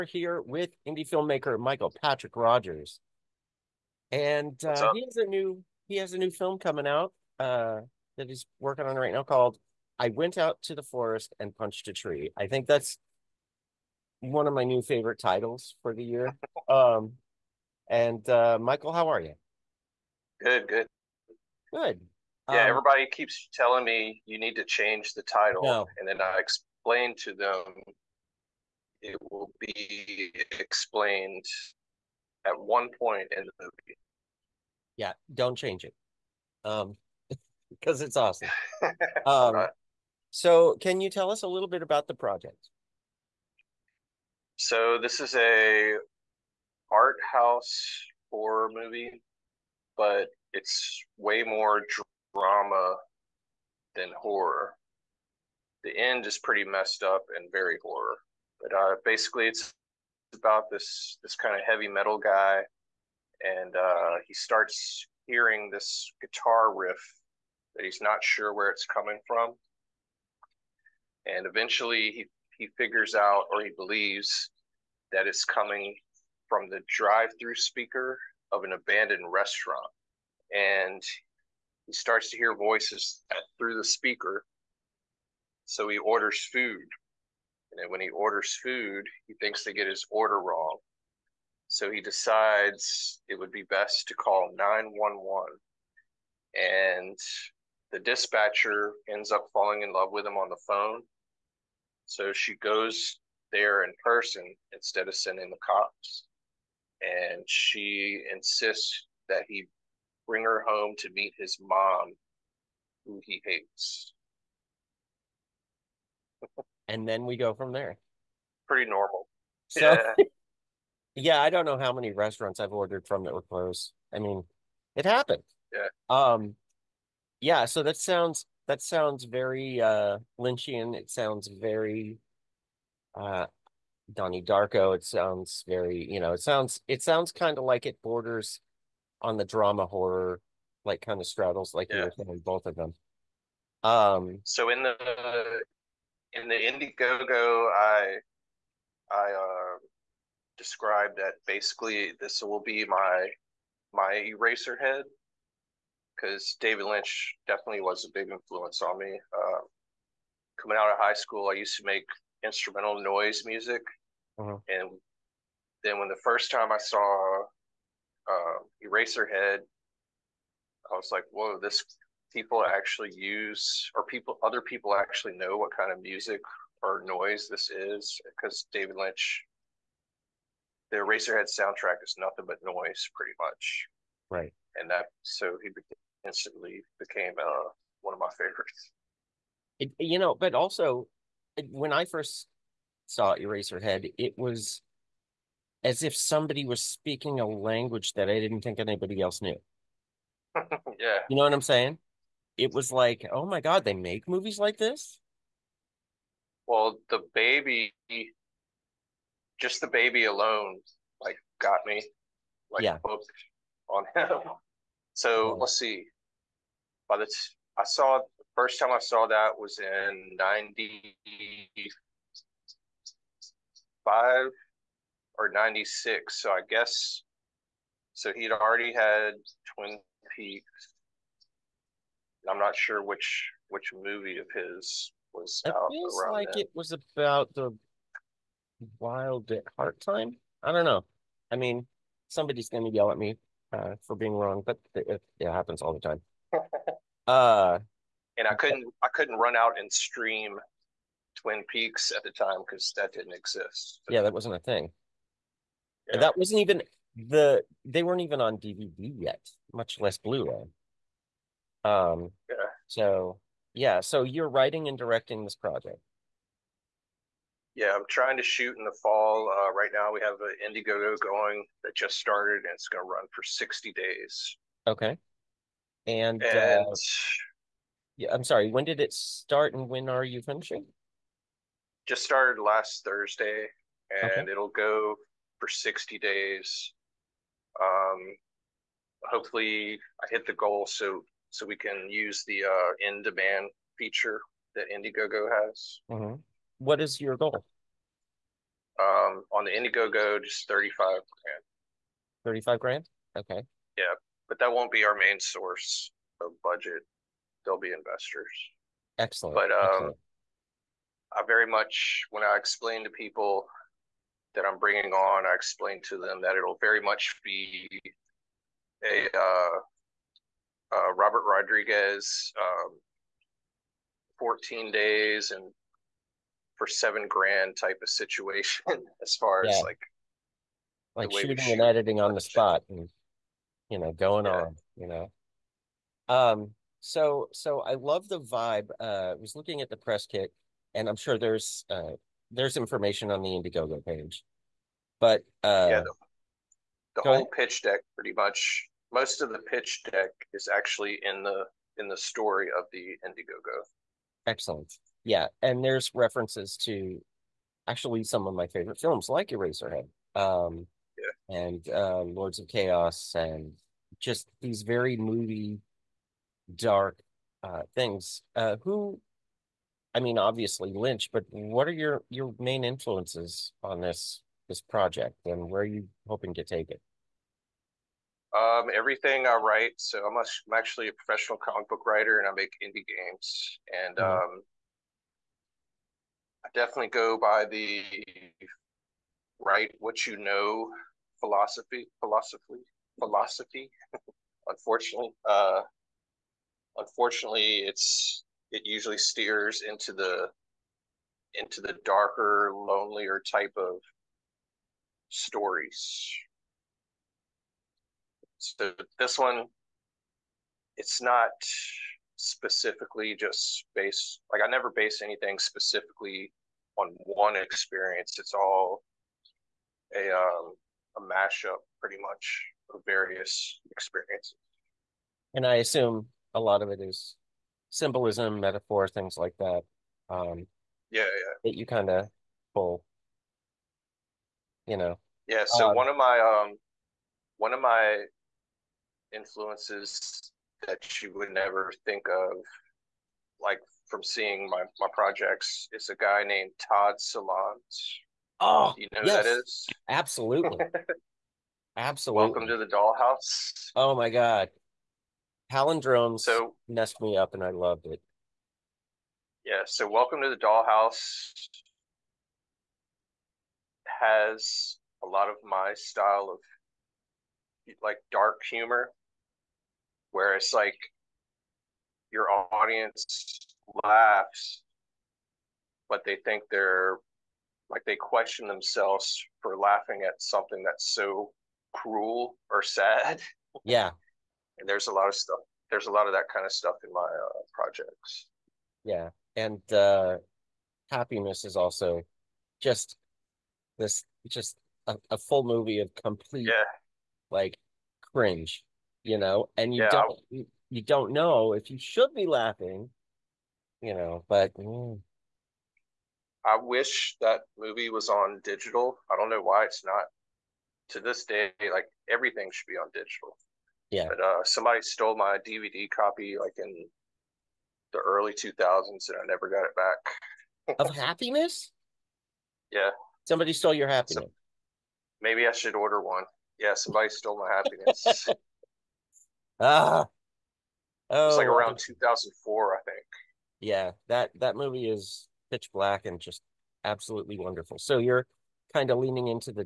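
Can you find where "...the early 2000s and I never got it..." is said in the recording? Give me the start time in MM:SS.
08:38.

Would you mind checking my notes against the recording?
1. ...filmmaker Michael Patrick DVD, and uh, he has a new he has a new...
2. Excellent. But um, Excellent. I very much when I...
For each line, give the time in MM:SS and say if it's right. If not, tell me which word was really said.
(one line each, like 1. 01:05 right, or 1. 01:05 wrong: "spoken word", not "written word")
1. 00:01 wrong: "Rodgers", not "DVD"
2. 05:09 right.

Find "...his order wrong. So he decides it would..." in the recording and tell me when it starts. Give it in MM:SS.
01:29.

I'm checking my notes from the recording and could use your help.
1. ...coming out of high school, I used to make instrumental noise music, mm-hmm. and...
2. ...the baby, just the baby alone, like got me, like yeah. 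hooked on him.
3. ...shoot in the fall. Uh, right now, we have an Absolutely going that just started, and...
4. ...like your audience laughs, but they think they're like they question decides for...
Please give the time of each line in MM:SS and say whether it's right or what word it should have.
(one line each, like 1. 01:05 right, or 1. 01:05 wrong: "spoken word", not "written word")
1. 02:40 right
2. 03:27 right
3. 04:28 wrong: "Indiegogo", not "Absolutely"
4. 07:50 wrong: "themselves", not "decides".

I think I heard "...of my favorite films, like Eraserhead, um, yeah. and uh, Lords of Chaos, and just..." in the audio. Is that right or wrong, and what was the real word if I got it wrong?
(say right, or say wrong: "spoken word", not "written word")
right.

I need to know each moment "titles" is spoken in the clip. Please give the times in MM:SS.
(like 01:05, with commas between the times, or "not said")
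00:15, 00:25.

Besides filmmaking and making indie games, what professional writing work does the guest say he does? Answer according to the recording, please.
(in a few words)
Comic book writer.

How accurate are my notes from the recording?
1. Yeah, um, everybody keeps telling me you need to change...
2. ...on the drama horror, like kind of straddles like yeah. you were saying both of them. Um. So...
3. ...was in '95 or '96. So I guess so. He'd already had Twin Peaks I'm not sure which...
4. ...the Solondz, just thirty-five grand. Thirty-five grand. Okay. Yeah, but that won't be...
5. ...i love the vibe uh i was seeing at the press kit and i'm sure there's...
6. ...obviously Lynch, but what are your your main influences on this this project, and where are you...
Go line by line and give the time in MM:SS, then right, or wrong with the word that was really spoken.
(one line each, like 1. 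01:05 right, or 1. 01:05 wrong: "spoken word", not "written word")
1. 00:22 right
2. 02:19 right
3. 03:39 right
4. 04:59 wrong: "Indiegogo", not "Solondz"
5. 05:37 wrong: "looking", not "seeing"
6. 06:10 right.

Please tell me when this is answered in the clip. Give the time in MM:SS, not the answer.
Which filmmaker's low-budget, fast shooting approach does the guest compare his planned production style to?
05:21.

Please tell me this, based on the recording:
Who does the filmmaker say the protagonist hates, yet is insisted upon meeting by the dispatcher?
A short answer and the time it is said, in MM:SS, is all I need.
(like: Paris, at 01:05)
His mom, at 01:51.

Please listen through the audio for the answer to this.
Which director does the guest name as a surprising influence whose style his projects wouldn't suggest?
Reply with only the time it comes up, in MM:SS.
07:26.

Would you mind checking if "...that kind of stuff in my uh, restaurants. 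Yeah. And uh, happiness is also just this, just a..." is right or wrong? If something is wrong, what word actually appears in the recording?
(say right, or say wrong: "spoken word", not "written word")
wrong: "projects", not "restaurants".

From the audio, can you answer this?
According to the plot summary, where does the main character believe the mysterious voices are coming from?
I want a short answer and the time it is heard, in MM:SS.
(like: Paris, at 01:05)
Drive-through speaker, at 01:16.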